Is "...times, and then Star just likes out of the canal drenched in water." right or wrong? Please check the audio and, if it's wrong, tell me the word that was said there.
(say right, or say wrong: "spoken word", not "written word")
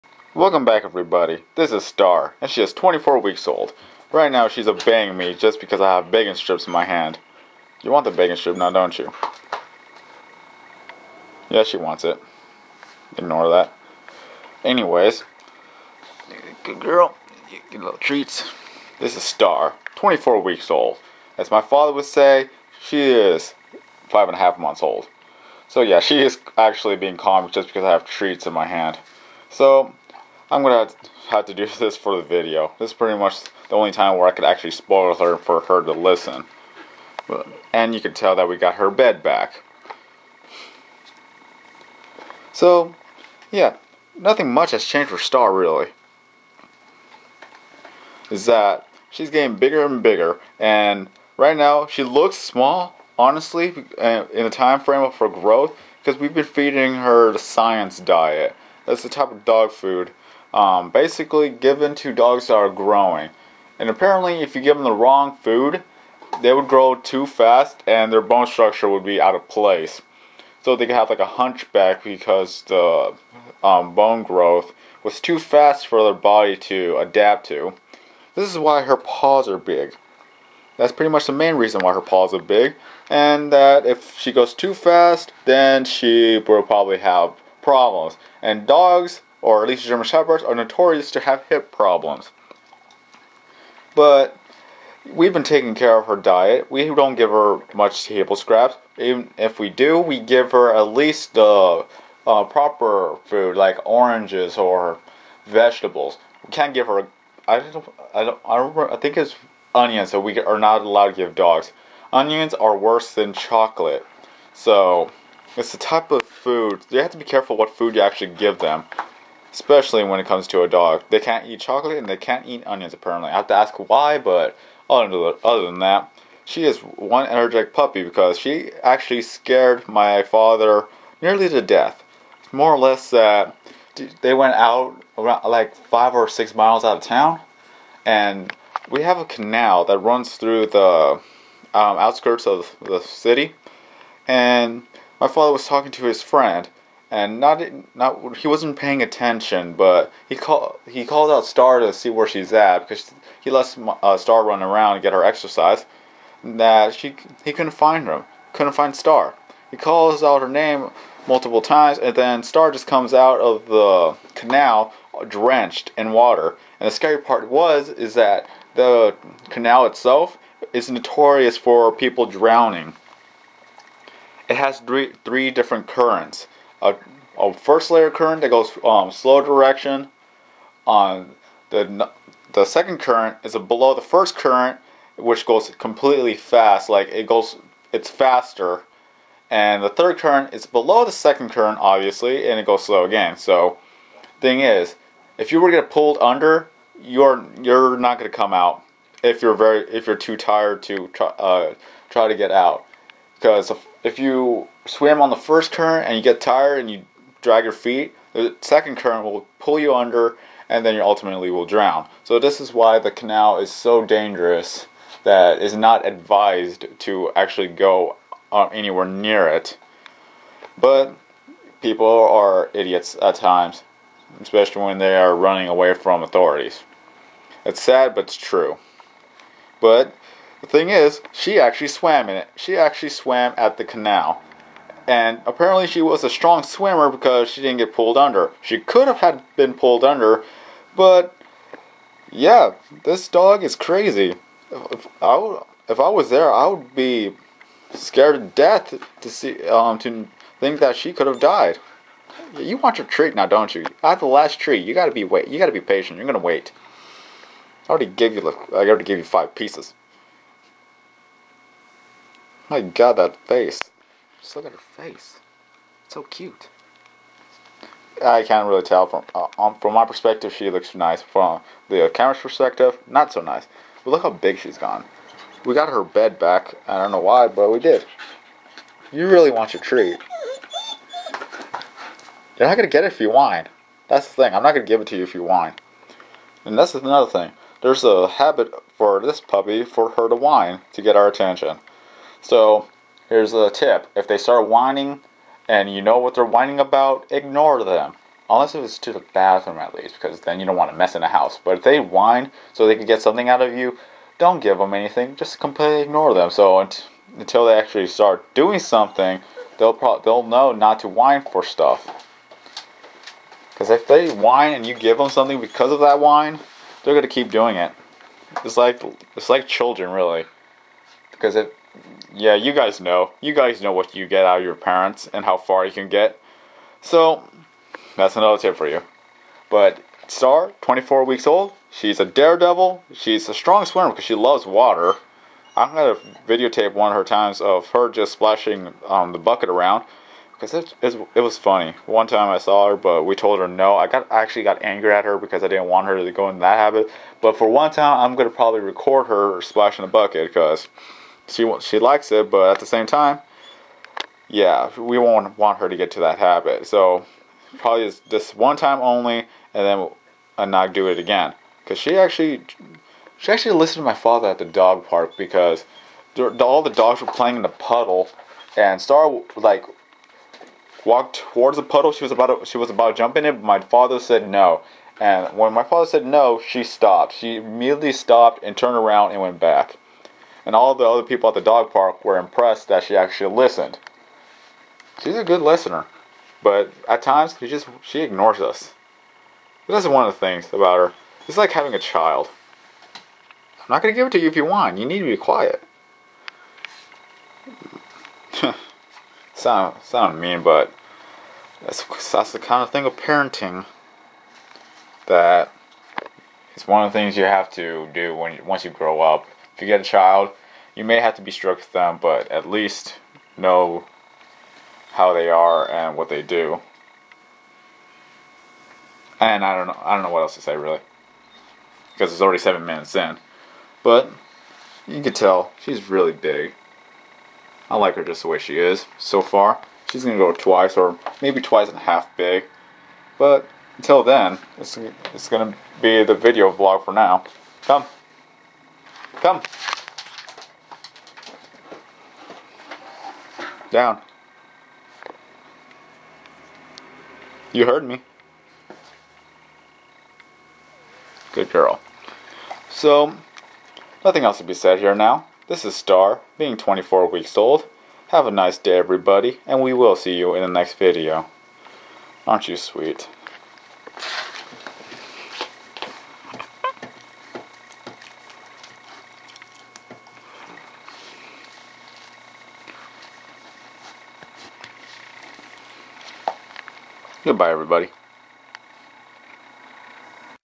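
wrong: "comes", not "likes".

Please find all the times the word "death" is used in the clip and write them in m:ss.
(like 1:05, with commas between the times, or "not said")
2:11, 4:08.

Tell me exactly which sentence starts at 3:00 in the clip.
On uh, the the second current is below the first current, which goes completely fast.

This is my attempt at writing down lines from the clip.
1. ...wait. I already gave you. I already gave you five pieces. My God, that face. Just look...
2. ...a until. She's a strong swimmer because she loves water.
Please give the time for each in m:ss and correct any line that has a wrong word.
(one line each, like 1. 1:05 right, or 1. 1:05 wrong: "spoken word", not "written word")
1. 4:16 right
2. 5:32 wrong: "daredevil", not "until".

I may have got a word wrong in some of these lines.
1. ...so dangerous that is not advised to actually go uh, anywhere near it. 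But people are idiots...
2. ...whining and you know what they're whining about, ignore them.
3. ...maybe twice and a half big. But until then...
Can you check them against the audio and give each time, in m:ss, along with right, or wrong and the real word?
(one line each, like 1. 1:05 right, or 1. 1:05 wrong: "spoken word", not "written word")
1. 3:33 right
2. 4:54 right
3. 7:11 right.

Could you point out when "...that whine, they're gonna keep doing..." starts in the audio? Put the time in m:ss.
5:16.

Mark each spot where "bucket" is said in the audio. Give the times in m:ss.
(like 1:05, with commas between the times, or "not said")
5:39, 5:50.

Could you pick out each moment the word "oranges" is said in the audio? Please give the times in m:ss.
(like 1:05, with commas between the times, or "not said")
1:43.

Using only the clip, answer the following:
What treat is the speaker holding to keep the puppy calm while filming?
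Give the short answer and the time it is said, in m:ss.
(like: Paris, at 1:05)
Bacon strips, at 0:06.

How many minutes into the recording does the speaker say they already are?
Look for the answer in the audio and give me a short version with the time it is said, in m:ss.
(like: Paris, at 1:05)
7, at 7:02.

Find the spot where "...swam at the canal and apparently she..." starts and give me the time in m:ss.
3:53.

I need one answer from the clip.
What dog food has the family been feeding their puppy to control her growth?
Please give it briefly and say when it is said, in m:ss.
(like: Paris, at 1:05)
Science diet, at 0:57.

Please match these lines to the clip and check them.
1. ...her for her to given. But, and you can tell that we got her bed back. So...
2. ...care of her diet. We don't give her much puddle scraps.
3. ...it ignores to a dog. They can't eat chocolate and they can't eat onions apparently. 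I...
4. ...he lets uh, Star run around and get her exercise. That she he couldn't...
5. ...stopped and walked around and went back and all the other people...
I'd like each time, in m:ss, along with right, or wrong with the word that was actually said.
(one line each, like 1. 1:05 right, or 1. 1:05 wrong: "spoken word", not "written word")
1. 0:35 wrong: "listen", not "given"
2. 1:35 wrong: "table", not "puddle"
3. 2:00 wrong: "comes", not "ignores"
4. 2:33 right
5. 6:18 wrong: "turned", not "walked".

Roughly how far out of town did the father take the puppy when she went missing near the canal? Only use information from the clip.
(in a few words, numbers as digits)
5 or 6 miles.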